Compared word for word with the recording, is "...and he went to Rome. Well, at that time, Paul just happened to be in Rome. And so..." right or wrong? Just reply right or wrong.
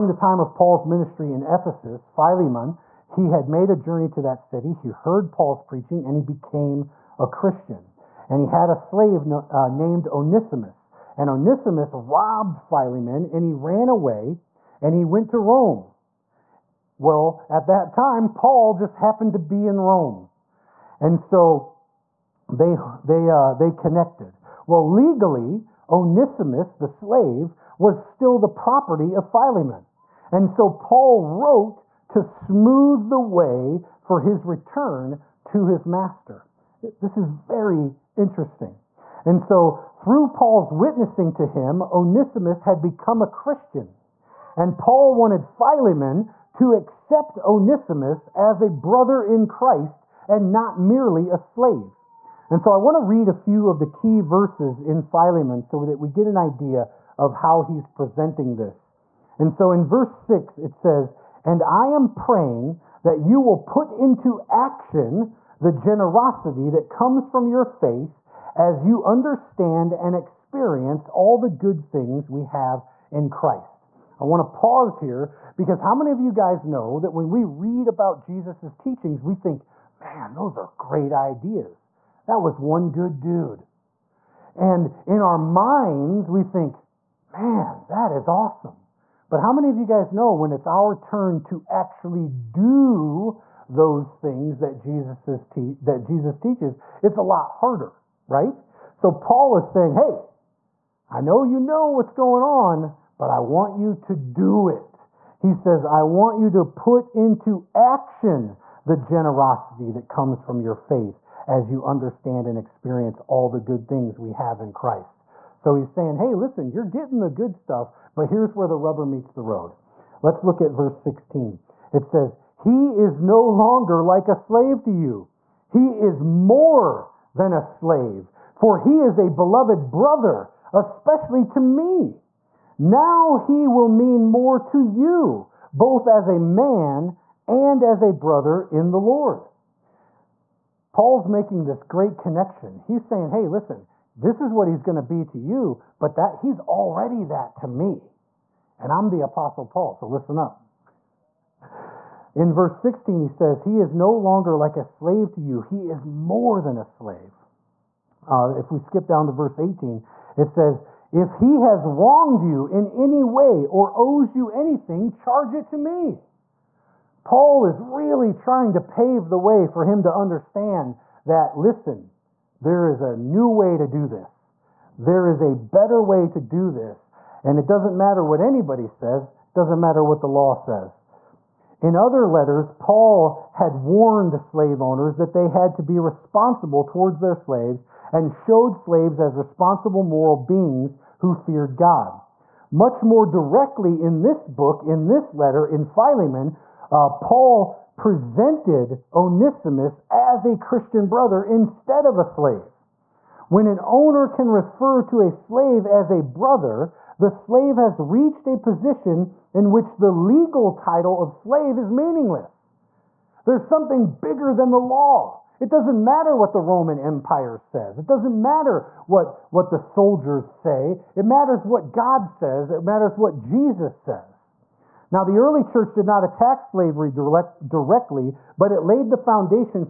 right.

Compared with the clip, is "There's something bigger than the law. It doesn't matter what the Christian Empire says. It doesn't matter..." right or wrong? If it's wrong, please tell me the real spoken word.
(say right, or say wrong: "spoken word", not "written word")
wrong: "Roman", not "Christian".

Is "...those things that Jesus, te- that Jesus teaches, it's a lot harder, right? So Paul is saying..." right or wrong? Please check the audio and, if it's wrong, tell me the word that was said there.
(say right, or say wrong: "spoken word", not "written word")
right.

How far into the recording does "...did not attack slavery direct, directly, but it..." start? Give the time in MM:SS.
03:45.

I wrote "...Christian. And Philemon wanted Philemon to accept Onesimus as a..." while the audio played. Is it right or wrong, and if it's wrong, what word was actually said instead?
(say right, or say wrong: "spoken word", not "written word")
wrong: "Paul", not "Philemon".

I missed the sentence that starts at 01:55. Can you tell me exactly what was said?
So he's saying, hey, listen, you're getting the good stuff, but here's where the rubber meets the road.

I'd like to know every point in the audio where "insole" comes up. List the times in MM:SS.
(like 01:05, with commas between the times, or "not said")
not said.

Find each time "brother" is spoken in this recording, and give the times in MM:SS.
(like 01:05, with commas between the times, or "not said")
00:48, 02:09, 02:18, 03:21, 03:26.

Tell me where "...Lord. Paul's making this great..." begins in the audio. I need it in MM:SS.
02:18.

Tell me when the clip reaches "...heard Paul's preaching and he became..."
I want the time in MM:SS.
00:04.